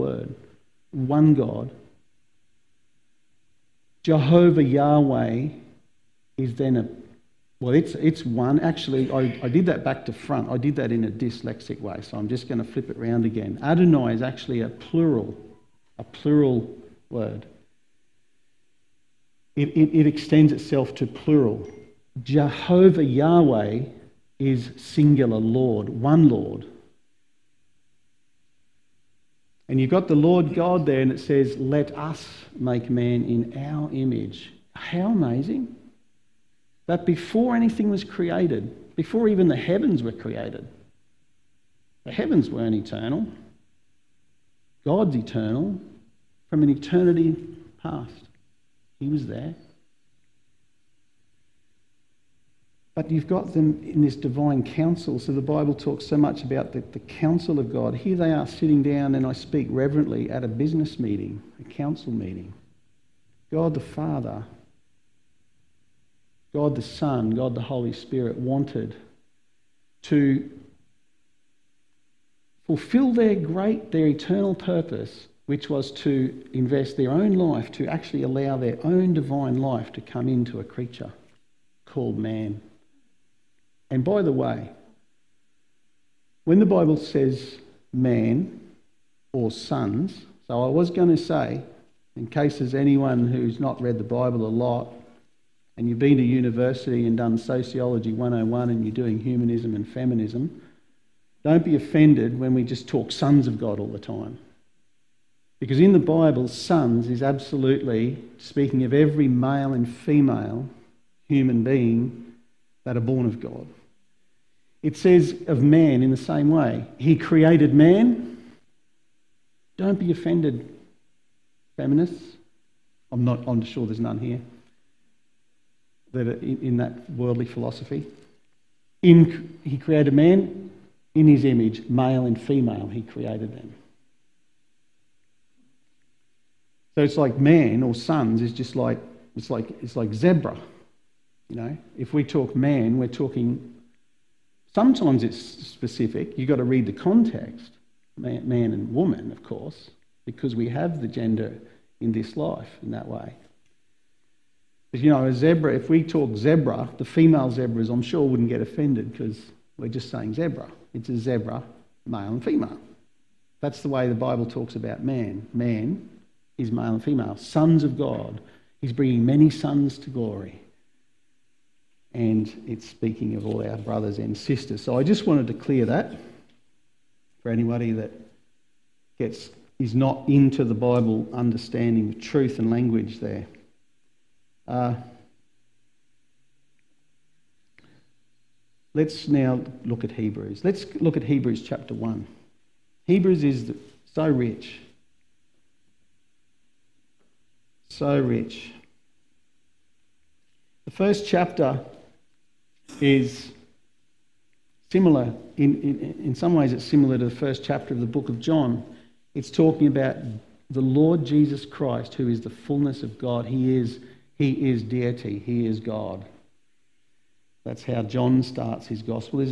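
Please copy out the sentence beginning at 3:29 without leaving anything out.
It's talking about the Lord Jesus Christ, who is the fullness of God.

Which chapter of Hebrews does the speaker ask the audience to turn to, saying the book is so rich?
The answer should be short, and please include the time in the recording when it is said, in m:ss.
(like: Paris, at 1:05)
Chapter 1, at 3:11.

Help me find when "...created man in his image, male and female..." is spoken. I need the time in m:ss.
2:09.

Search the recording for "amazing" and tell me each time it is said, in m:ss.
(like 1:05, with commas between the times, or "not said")
0:35.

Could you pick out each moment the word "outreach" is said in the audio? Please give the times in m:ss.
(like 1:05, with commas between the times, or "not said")
not said.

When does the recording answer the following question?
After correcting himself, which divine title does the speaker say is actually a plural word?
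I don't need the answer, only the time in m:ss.
0:13.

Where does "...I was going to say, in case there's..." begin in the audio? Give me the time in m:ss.
1:30.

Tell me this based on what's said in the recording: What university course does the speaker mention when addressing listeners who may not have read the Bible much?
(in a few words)
Sociology 101.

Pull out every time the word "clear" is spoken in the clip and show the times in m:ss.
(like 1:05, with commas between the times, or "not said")
2:55.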